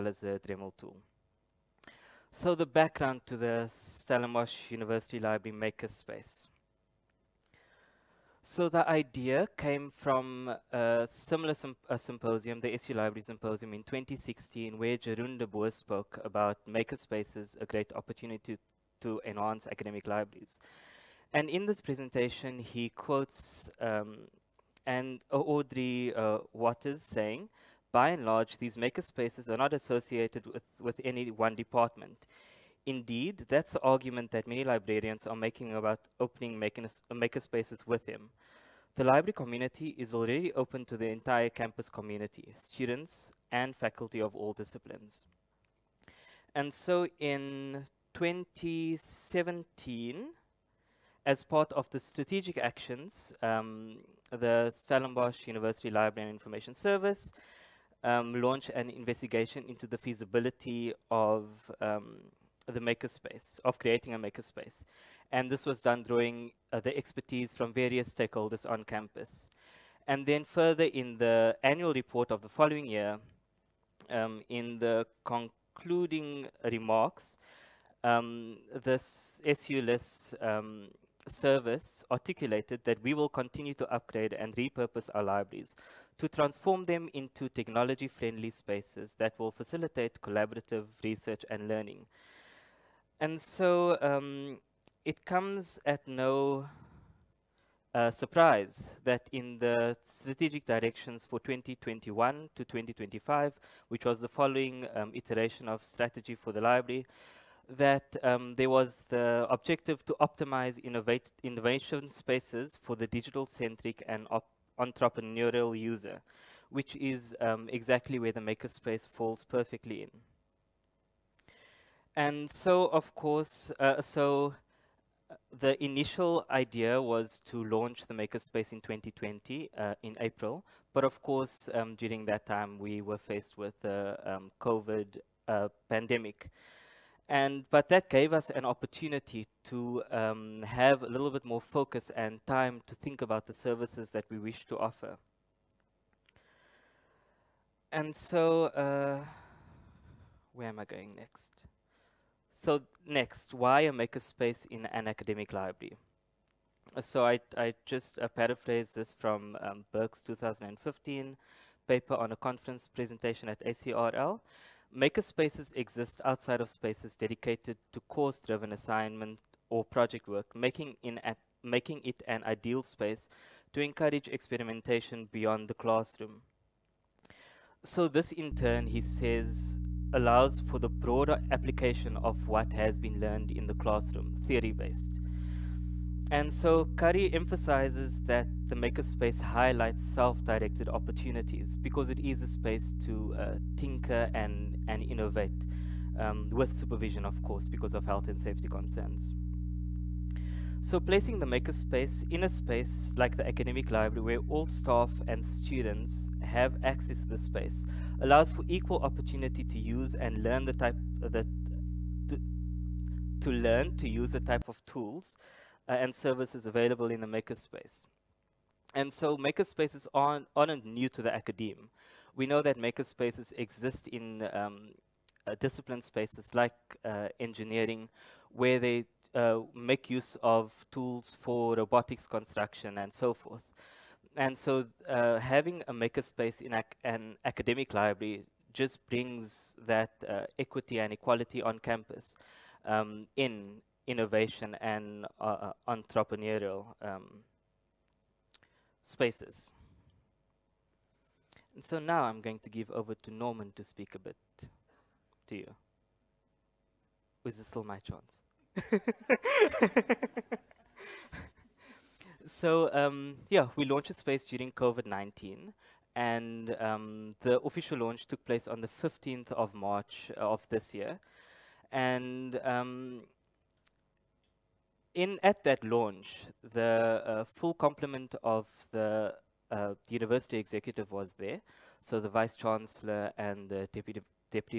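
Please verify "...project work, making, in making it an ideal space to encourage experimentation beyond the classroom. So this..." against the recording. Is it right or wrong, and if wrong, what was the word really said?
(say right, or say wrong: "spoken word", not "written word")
right.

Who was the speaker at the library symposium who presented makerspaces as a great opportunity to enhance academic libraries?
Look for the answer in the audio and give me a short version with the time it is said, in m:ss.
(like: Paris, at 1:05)
Jeroen de Boer, at 0:14.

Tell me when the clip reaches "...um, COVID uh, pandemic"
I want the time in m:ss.
2:14.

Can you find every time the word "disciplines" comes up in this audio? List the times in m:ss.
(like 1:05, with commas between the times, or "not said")
0:44, 3:45.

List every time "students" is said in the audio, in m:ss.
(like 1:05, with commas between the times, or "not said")
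0:42, 3:25.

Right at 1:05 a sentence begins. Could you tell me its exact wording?
And this was done drawing uh, the expertise from various stakeholders on campus.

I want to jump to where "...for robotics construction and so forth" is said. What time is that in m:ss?
3:51.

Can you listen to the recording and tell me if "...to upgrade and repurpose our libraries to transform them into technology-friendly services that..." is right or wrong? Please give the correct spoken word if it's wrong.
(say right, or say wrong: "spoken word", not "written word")
wrong: "spaces", not "services".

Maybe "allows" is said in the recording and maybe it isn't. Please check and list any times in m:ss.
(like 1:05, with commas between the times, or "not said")
3:00, 3:28.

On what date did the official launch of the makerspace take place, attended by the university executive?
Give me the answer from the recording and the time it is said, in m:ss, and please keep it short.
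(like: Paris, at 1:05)
15 March, at 4:28.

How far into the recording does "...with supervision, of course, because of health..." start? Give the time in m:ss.
3:16.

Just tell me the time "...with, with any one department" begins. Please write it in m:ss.
0:30.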